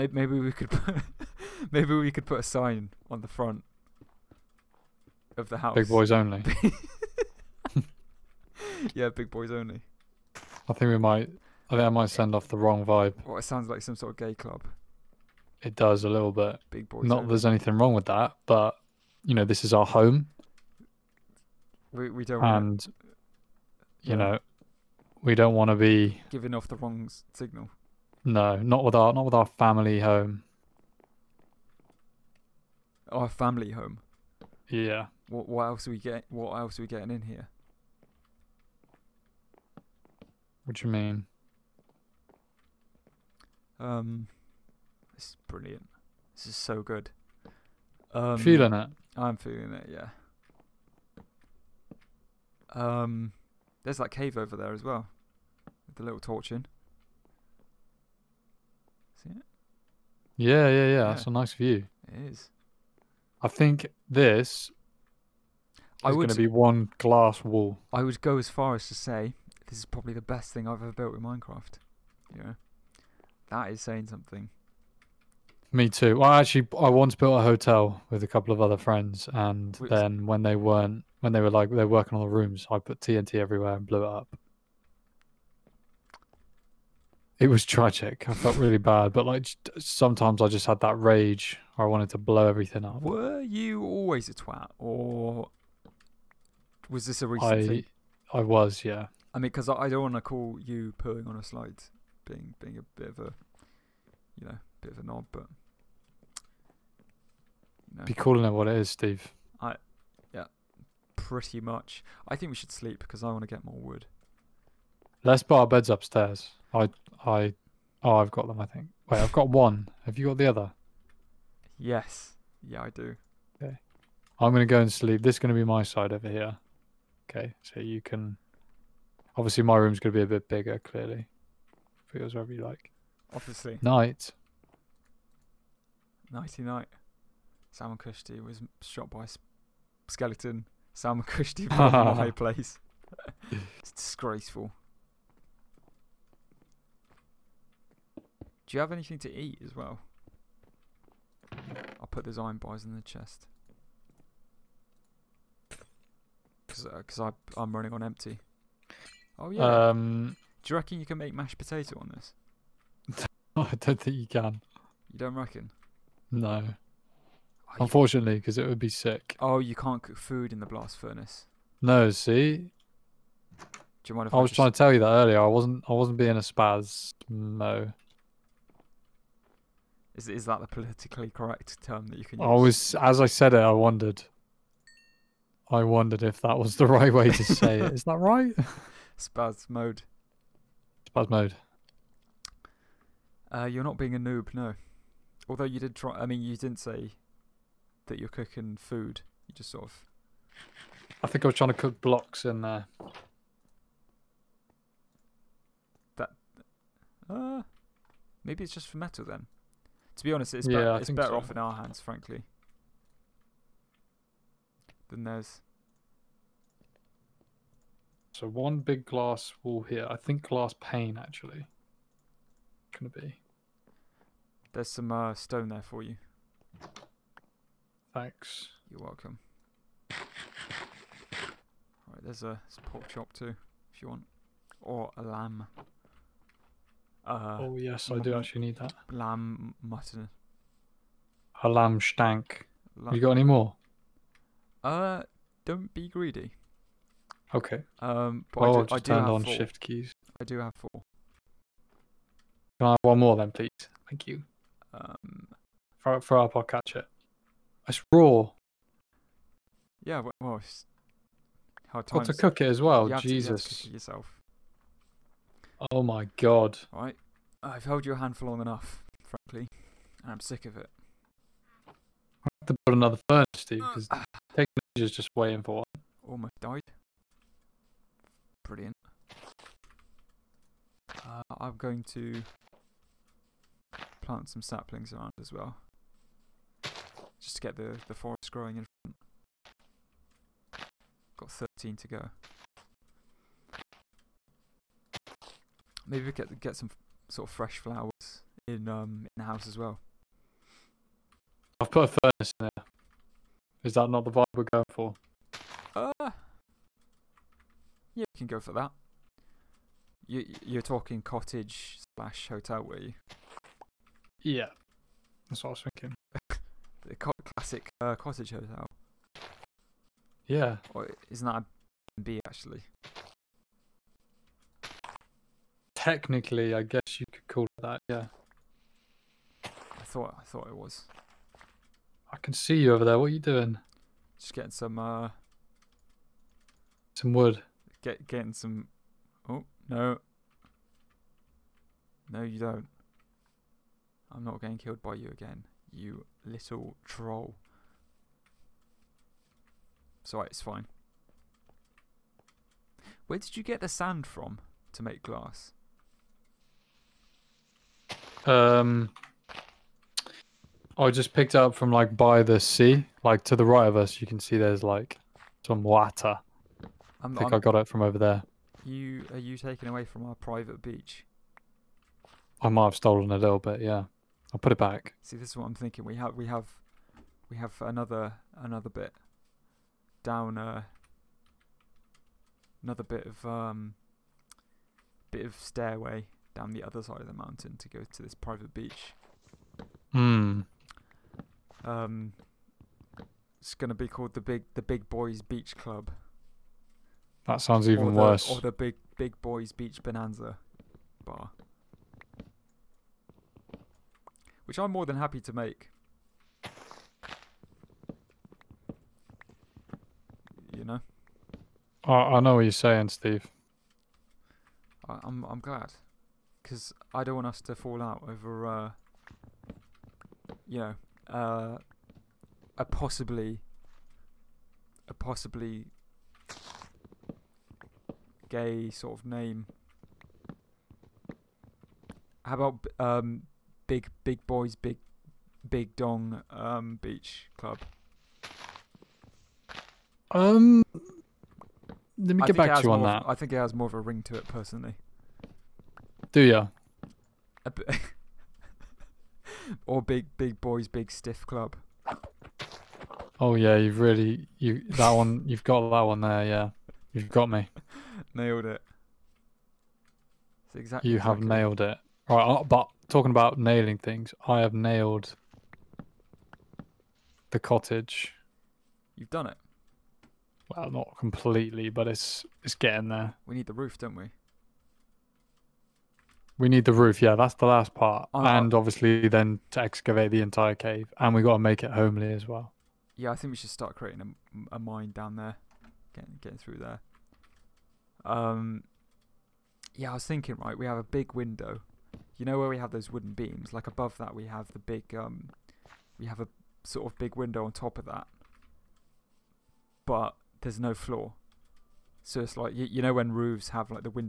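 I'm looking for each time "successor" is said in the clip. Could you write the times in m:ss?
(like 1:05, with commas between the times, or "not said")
not said.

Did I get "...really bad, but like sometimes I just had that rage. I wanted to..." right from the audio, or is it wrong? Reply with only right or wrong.
right.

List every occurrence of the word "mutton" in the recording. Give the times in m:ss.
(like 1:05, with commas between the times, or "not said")
3:59.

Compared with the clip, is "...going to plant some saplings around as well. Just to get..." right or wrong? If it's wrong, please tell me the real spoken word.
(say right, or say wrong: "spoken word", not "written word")
right.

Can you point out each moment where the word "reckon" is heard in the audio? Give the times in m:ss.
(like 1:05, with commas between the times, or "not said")
2:40, 2:45.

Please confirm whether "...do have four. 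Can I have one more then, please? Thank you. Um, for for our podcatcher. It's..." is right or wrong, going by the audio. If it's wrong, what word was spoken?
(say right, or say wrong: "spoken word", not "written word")
right.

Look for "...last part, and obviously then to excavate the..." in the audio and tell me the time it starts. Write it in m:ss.
7:57.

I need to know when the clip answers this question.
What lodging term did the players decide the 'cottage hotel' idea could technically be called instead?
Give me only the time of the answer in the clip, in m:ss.
5:21.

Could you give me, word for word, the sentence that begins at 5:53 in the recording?
Where did you get the sand from to make glass?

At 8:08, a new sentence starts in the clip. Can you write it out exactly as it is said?
Um, yeah, I was thinking, right, we have a big window.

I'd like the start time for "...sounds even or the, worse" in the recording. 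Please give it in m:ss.
6:37.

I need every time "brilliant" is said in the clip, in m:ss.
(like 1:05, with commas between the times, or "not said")
0:45, 4:38.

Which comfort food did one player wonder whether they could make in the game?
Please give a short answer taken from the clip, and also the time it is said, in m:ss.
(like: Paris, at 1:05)
Mashed potato, at 2:41.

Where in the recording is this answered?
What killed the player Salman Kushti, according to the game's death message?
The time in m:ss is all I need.
2:20.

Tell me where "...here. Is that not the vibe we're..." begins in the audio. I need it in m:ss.
5:02.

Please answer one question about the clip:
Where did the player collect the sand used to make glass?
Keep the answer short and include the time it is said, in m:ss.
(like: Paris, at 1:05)
By the sea, at 6:02.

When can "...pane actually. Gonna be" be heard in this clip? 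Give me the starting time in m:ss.
3:40.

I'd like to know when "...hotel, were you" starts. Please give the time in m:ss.
5:12.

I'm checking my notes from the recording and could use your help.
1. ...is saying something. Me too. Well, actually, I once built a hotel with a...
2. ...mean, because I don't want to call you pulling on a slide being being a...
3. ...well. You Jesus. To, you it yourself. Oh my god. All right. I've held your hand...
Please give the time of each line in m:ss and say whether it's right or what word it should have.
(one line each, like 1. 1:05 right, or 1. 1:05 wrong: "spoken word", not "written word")
1. 1:13 right
2. 1:39 right
3. 4:22 right.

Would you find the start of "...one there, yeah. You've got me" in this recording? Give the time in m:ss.
7:36.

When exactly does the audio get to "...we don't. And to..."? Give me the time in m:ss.
0:22.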